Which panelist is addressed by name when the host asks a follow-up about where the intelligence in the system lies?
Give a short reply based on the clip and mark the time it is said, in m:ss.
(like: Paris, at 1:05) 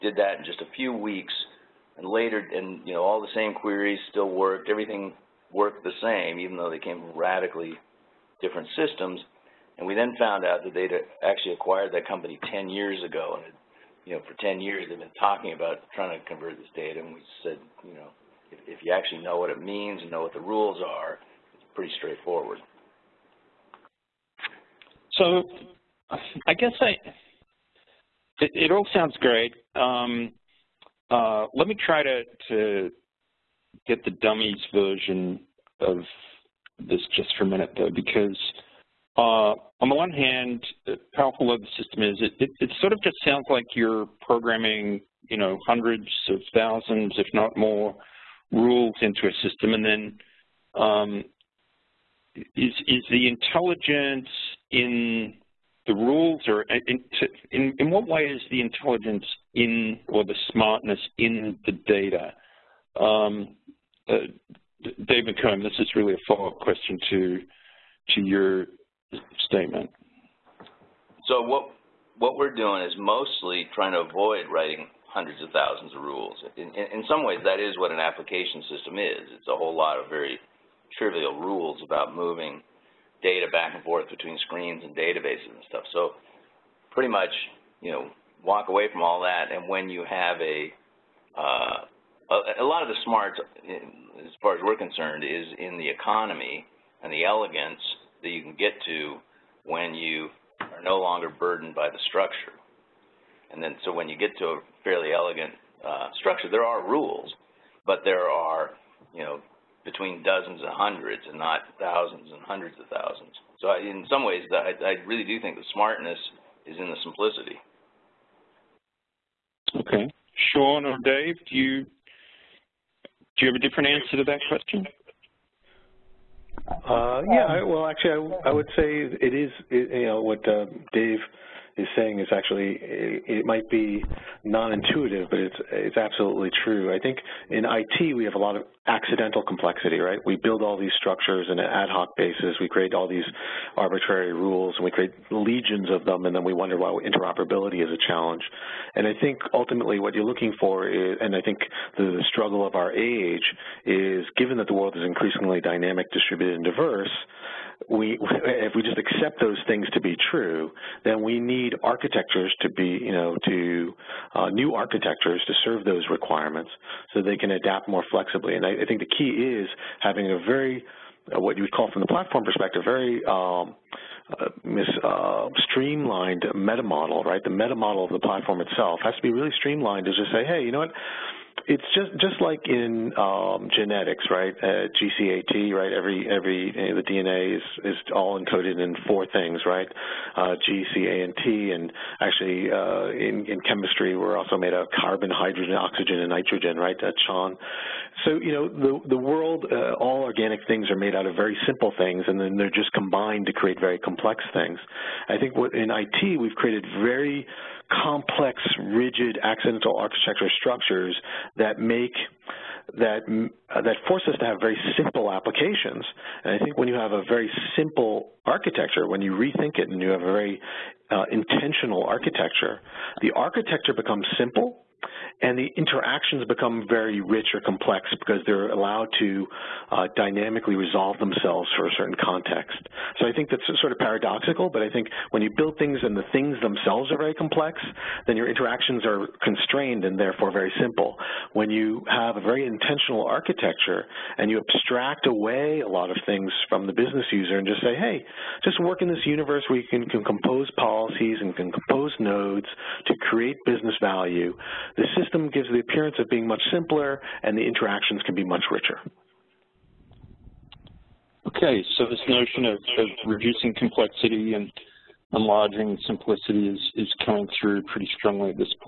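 Dave McComb, at 1:05.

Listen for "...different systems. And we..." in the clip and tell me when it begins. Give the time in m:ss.
0:08.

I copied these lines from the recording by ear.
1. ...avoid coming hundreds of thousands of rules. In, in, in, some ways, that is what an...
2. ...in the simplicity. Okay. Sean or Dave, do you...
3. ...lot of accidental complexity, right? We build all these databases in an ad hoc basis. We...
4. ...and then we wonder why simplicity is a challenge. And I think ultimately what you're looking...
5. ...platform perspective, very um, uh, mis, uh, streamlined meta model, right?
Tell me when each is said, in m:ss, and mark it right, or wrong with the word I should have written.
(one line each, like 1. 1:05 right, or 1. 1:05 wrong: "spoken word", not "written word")
1. 1:13 wrong: "writing", not "coming"
2. 1:56 right
3. 2:18 wrong: "structures", not "databases"
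4. 2:26 wrong: "interoperability", not "simplicity"
5. 2:52 right.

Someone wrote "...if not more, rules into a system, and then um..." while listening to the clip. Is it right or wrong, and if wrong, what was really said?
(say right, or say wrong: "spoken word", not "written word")
right.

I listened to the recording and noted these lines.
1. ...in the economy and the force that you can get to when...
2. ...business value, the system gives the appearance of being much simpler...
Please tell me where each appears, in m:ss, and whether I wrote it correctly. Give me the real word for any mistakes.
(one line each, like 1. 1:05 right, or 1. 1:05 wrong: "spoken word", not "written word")
1. 1:35 wrong: "elegance", not "force"
2. 4:13 right.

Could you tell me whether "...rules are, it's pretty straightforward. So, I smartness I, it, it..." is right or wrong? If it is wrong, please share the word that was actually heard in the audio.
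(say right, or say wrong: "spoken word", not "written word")
wrong: "guess", not "smartness".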